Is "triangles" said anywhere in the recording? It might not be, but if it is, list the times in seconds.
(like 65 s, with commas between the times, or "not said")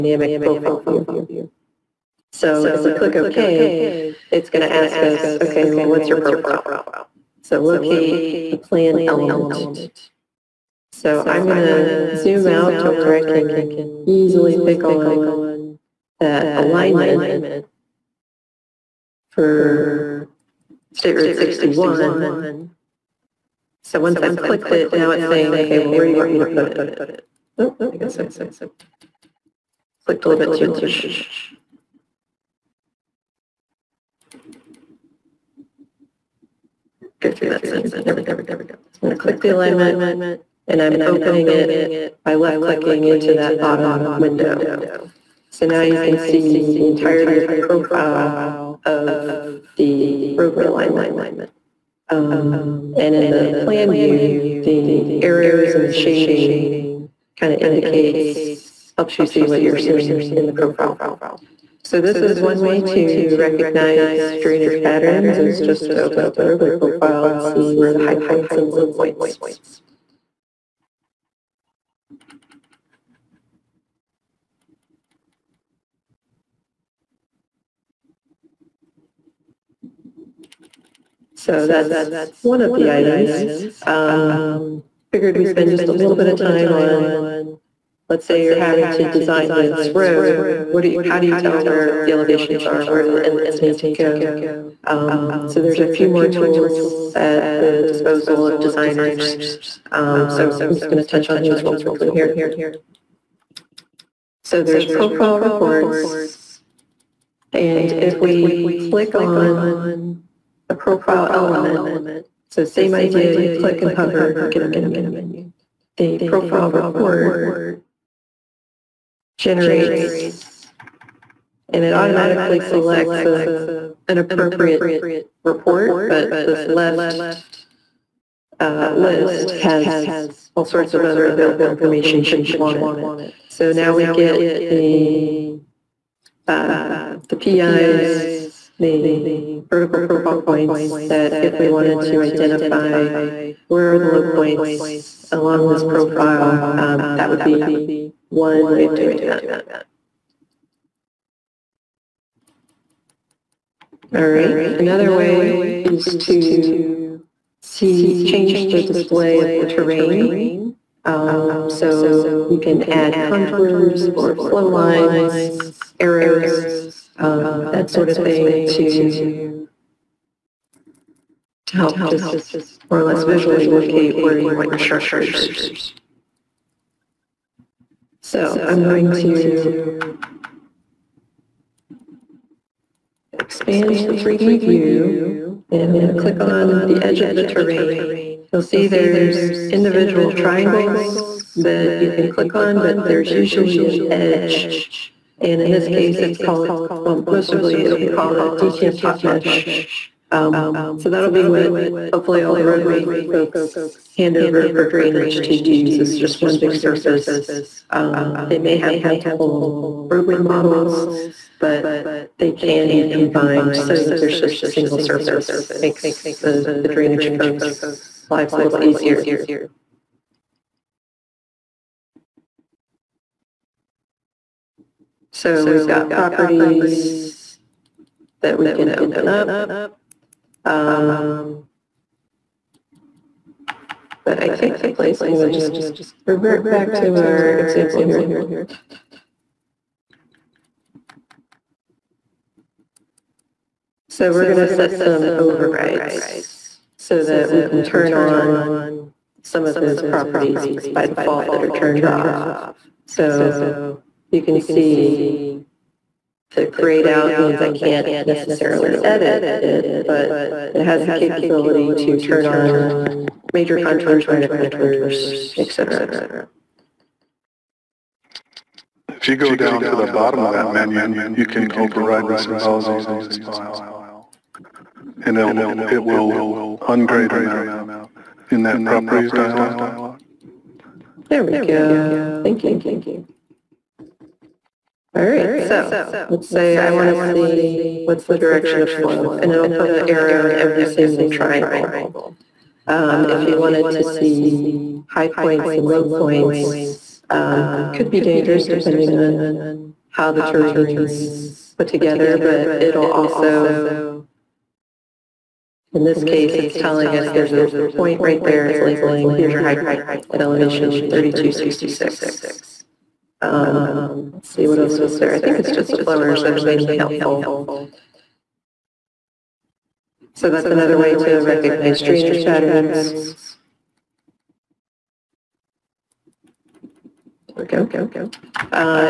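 190 s, 291 s.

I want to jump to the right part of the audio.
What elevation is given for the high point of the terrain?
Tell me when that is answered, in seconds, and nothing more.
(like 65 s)
311 s.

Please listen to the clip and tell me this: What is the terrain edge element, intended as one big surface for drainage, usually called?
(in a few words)
DTM top mesh.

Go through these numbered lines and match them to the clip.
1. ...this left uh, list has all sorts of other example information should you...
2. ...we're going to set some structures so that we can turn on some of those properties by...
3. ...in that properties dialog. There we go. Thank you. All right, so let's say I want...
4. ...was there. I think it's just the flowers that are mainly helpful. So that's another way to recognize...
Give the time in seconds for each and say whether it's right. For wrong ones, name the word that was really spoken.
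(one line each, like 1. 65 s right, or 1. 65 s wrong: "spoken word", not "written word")
1. 126 s wrong: "available", not "example"
2. 244 s wrong: "overrides", not "structures"
3. 278 s right
4. 314 s right.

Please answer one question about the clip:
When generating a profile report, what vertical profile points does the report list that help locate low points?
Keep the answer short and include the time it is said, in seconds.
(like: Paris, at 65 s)
PIs, at 137 s.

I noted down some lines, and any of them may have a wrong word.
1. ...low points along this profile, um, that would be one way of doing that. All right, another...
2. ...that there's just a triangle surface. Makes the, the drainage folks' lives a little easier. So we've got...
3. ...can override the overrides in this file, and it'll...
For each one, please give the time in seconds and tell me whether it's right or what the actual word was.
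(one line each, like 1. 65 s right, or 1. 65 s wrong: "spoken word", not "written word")
1. 144 s right
2. 214 s wrong: "single", not "triangle"
3. 271 s wrong: "symbologies", not "overrides".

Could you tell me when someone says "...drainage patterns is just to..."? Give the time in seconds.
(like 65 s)
64 s.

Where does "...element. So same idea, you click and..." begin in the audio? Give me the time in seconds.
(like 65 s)
111 s.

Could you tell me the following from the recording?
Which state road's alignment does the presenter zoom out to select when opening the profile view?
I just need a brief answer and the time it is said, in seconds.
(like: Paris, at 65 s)
State Road 61, at 20 s.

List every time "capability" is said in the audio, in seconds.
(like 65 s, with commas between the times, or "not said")
261 s.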